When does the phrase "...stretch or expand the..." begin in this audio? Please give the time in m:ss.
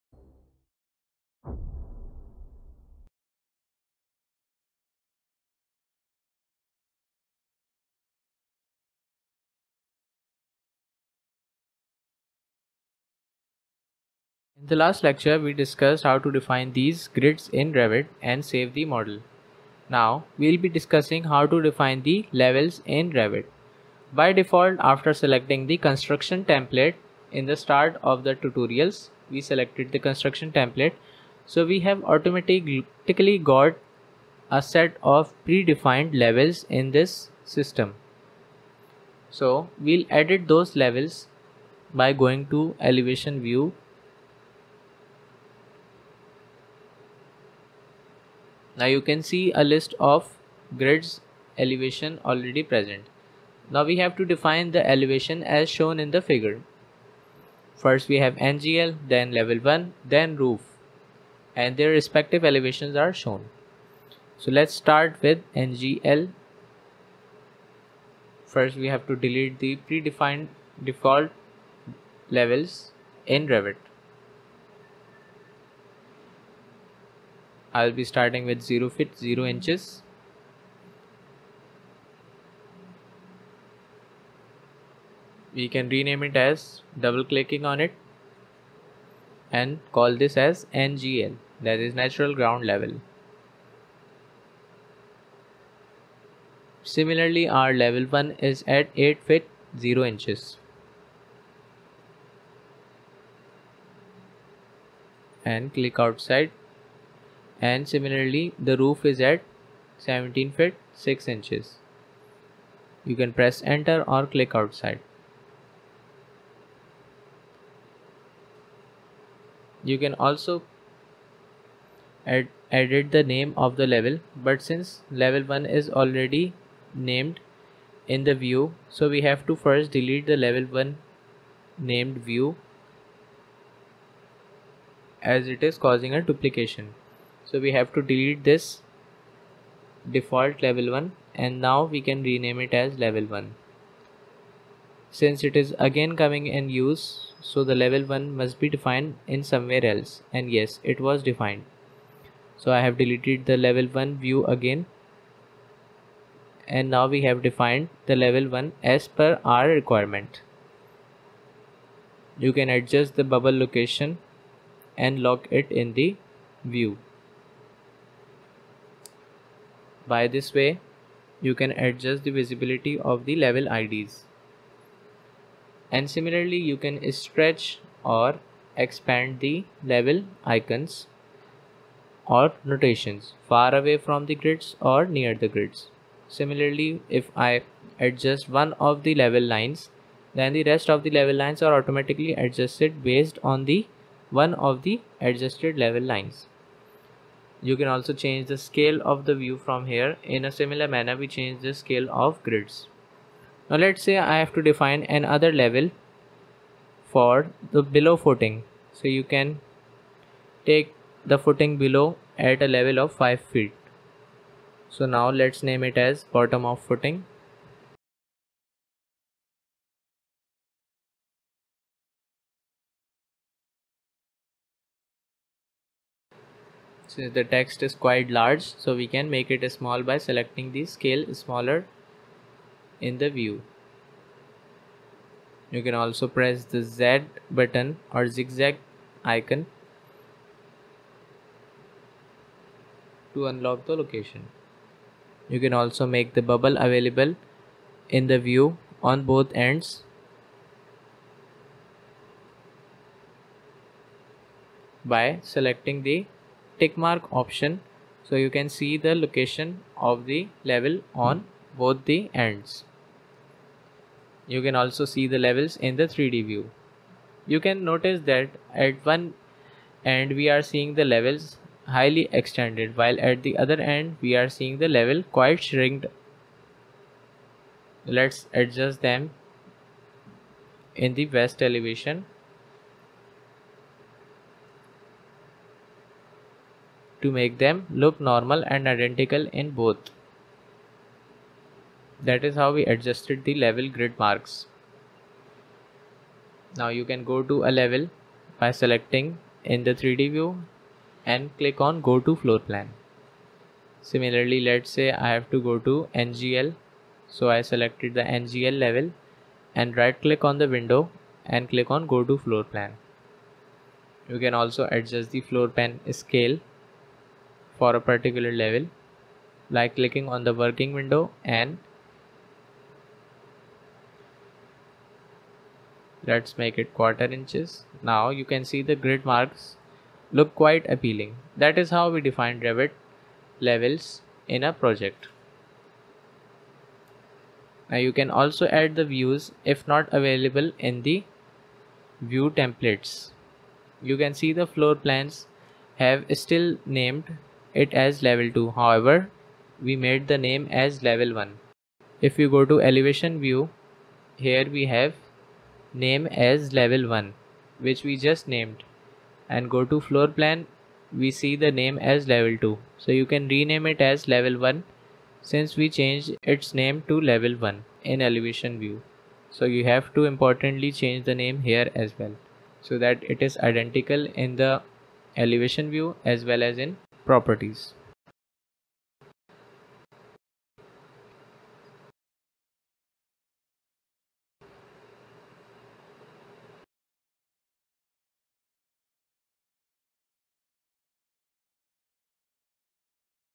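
2:57.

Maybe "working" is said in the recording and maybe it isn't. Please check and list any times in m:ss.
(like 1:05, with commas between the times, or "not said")
5:20.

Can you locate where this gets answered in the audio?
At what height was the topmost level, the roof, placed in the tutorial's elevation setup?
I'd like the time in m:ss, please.
1:49.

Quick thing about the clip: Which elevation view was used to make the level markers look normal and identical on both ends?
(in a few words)
West elevation.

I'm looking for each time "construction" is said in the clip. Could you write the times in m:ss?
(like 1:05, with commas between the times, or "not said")
0:25, 0:29.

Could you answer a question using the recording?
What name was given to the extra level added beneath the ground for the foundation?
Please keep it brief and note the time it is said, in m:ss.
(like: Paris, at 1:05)
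Bottom of footing, at 3:36.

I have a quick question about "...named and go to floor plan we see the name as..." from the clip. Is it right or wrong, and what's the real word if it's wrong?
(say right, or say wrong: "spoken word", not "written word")
right.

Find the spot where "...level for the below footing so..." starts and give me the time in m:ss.
3:25.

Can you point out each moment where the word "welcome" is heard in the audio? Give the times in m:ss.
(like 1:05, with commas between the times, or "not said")
not said.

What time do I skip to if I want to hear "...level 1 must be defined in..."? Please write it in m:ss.
2:27.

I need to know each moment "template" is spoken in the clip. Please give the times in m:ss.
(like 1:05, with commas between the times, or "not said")
0:26, 0:30, 5:42.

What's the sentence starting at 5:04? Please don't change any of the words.
Similarly, let's say I have to go to NGL.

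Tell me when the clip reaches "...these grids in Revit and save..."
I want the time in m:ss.
0:16.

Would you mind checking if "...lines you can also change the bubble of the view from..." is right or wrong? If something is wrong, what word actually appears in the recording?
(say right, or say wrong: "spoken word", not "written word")
wrong: "scale", not "bubble".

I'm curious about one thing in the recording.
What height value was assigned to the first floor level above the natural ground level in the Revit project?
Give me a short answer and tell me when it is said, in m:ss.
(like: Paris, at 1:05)
8 feet 0 inches, at 1:38.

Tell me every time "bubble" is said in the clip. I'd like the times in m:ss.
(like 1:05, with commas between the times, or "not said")
2:43, 4:06.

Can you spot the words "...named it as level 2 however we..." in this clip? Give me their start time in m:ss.
5:46.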